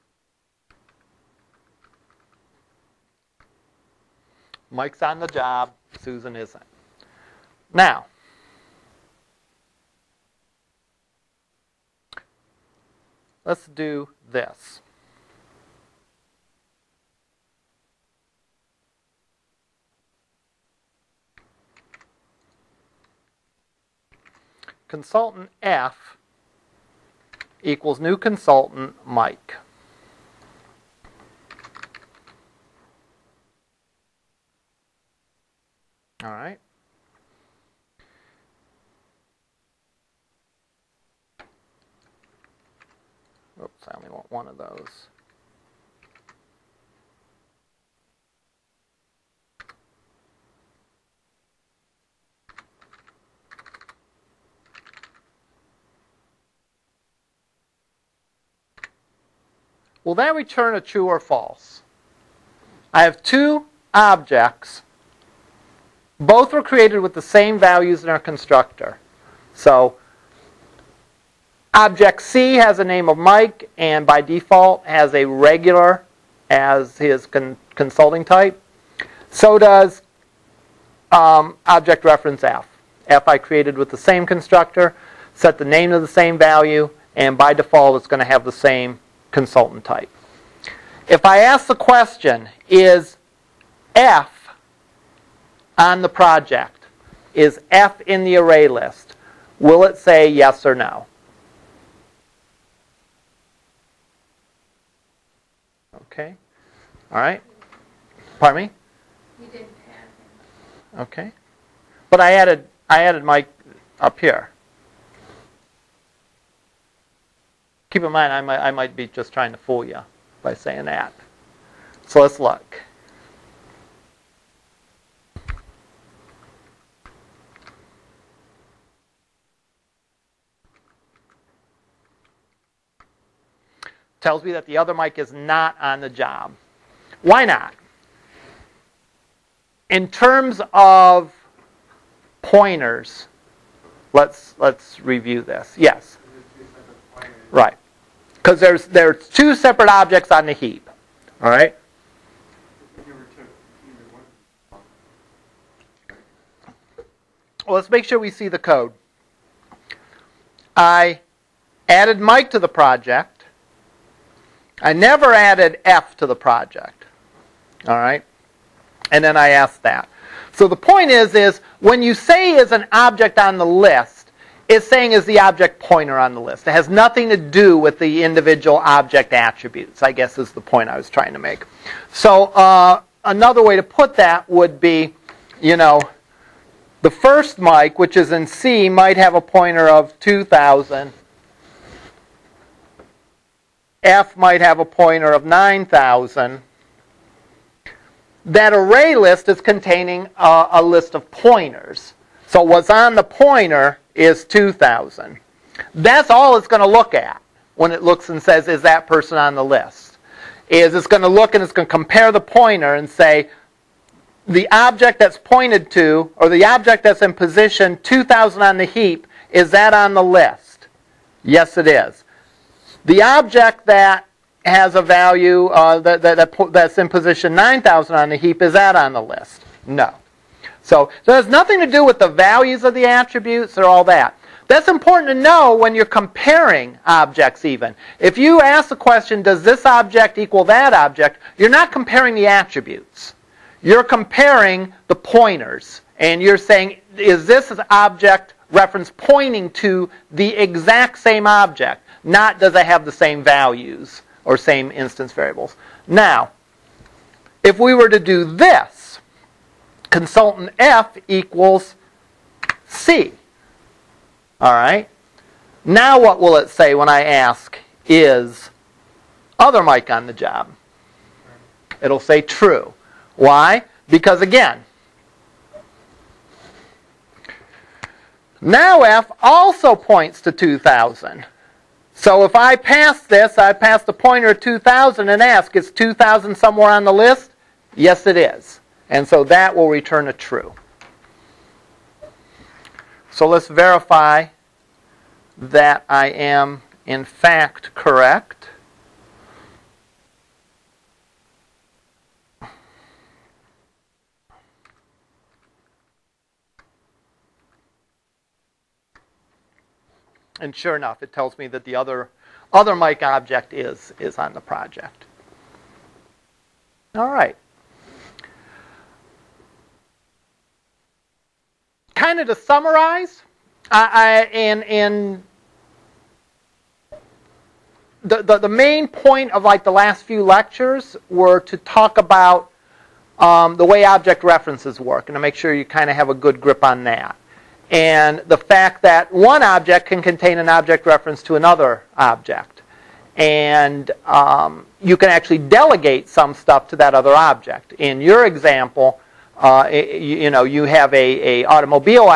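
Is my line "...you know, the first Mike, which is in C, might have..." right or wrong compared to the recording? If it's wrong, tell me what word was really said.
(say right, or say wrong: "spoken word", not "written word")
right.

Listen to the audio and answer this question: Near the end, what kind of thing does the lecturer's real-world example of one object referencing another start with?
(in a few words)
automobile.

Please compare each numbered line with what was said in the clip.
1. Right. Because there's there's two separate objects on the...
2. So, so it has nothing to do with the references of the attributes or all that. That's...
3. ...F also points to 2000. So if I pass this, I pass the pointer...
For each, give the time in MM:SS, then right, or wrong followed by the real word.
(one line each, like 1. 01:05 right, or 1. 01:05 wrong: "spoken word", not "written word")
1. 02:27 right
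2. 03:50 wrong: "values", not "references"
3. 04:39 right.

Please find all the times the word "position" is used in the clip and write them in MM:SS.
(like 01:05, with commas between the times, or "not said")
03:37, 03:47.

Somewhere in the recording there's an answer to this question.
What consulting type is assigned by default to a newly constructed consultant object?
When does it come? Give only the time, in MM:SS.
01:15.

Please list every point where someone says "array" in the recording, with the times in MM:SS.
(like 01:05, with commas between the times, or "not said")
01:38, 03:18.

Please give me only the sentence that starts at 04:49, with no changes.
And so that will return a true.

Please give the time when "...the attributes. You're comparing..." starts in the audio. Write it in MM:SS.
04:02.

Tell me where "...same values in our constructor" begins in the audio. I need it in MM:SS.
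01:07.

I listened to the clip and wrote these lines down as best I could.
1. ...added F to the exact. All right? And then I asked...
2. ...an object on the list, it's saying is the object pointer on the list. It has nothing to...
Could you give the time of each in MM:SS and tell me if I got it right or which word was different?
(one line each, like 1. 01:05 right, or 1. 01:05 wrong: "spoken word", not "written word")
1. 02:45 wrong: "project", not "exact"
2. 02:52 right.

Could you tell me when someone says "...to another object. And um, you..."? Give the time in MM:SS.
05:41.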